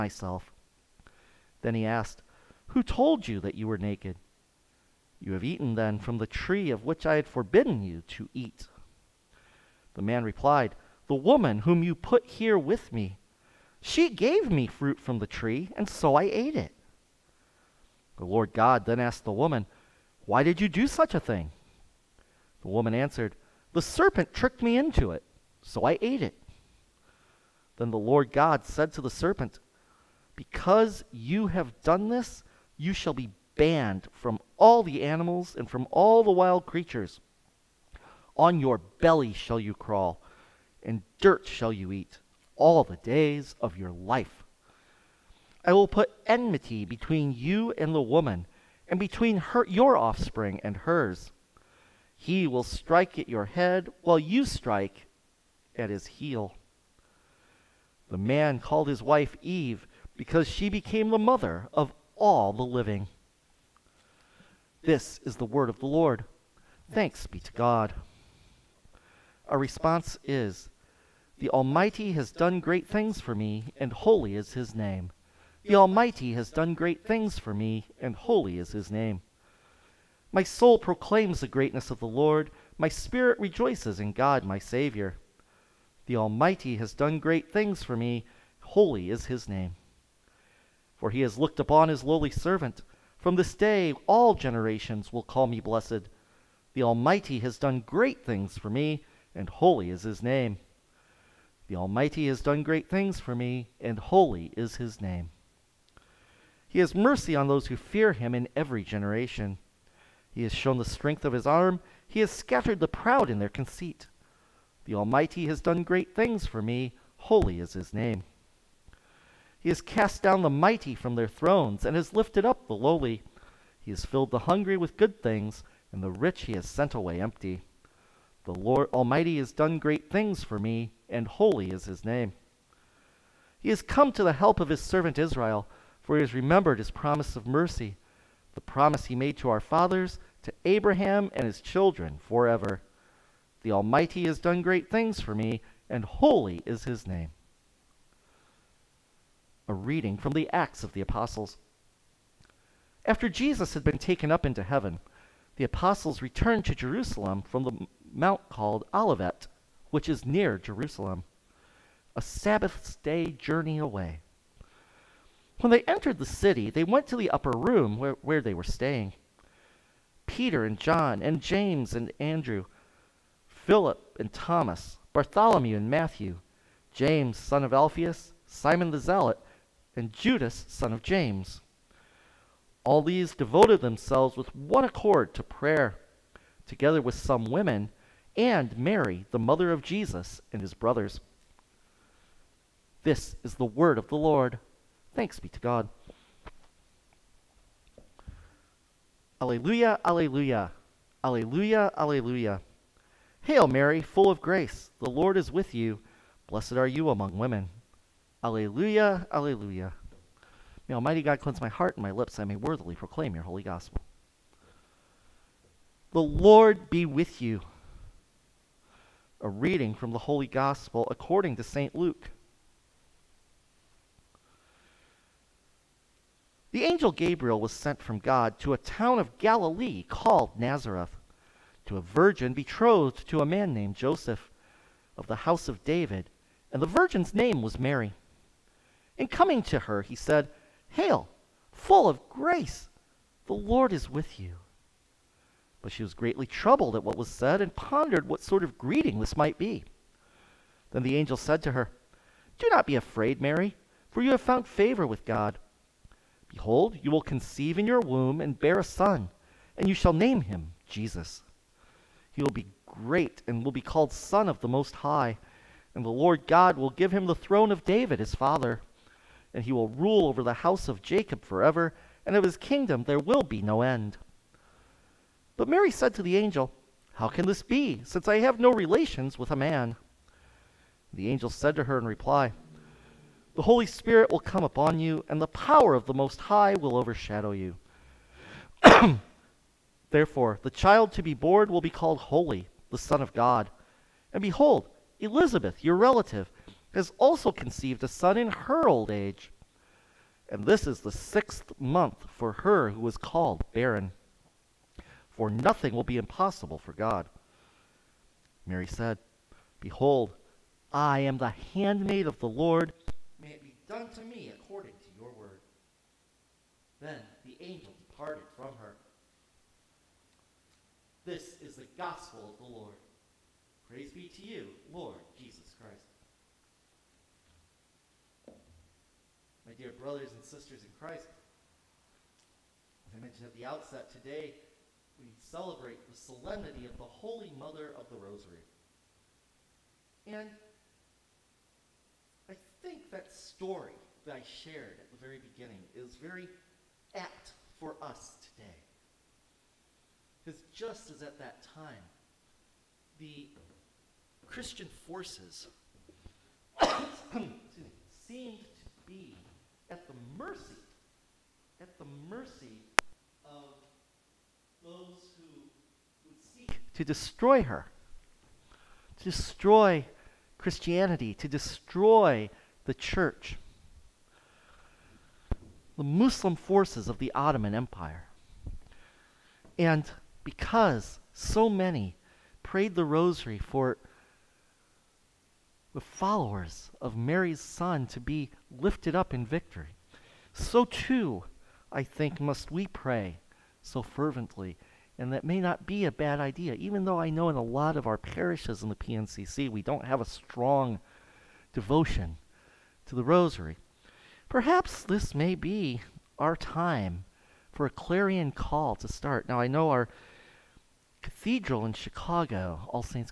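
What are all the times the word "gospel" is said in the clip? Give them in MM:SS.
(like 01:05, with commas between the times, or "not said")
03:33, 03:40, 05:21.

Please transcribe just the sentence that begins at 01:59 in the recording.
He has cast down the mighty from their thrones, and has lifted up the lowly.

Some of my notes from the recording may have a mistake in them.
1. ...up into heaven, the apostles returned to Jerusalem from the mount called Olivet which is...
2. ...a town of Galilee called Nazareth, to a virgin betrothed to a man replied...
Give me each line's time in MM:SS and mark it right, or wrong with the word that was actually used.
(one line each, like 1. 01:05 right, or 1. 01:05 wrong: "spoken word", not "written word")
1. 02:34 right
2. 03:48 wrong: "named", not "replied".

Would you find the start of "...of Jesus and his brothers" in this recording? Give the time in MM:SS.
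03:09.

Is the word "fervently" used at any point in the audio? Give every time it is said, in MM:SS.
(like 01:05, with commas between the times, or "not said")
06:34.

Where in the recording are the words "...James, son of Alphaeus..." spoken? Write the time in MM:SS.
02:56.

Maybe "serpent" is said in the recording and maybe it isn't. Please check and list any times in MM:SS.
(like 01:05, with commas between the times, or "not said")
00:23, 00:29.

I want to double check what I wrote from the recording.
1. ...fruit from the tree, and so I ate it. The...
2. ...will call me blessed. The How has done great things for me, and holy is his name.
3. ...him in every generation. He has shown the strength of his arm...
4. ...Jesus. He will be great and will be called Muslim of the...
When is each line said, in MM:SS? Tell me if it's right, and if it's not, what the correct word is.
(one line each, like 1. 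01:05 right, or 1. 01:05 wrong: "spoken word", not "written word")
1. 00:14 right
2. 01:35 wrong: "Almighty", not "How"
3. 01:48 right
4. 04:20 wrong: "Son", not "Muslim".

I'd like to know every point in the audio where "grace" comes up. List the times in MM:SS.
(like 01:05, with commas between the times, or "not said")
03:24, 04:02.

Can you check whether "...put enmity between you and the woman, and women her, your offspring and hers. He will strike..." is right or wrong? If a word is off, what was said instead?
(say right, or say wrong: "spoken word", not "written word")
wrong: "between", not "women".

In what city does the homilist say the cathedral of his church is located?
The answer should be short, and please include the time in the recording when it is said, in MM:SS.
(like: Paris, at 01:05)
Chicago, at 06:51.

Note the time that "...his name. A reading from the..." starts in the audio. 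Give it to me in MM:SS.
02:26.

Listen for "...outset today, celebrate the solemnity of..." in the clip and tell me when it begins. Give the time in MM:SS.
05:33.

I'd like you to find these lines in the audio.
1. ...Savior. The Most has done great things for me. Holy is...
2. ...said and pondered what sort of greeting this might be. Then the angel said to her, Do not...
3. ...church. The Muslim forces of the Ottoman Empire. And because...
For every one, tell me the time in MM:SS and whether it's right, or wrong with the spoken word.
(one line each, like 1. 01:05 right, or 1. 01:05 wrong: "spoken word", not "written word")
1. 01:24 wrong: "Almighty", not "Most"
2. 04:07 right
3. 06:12 right.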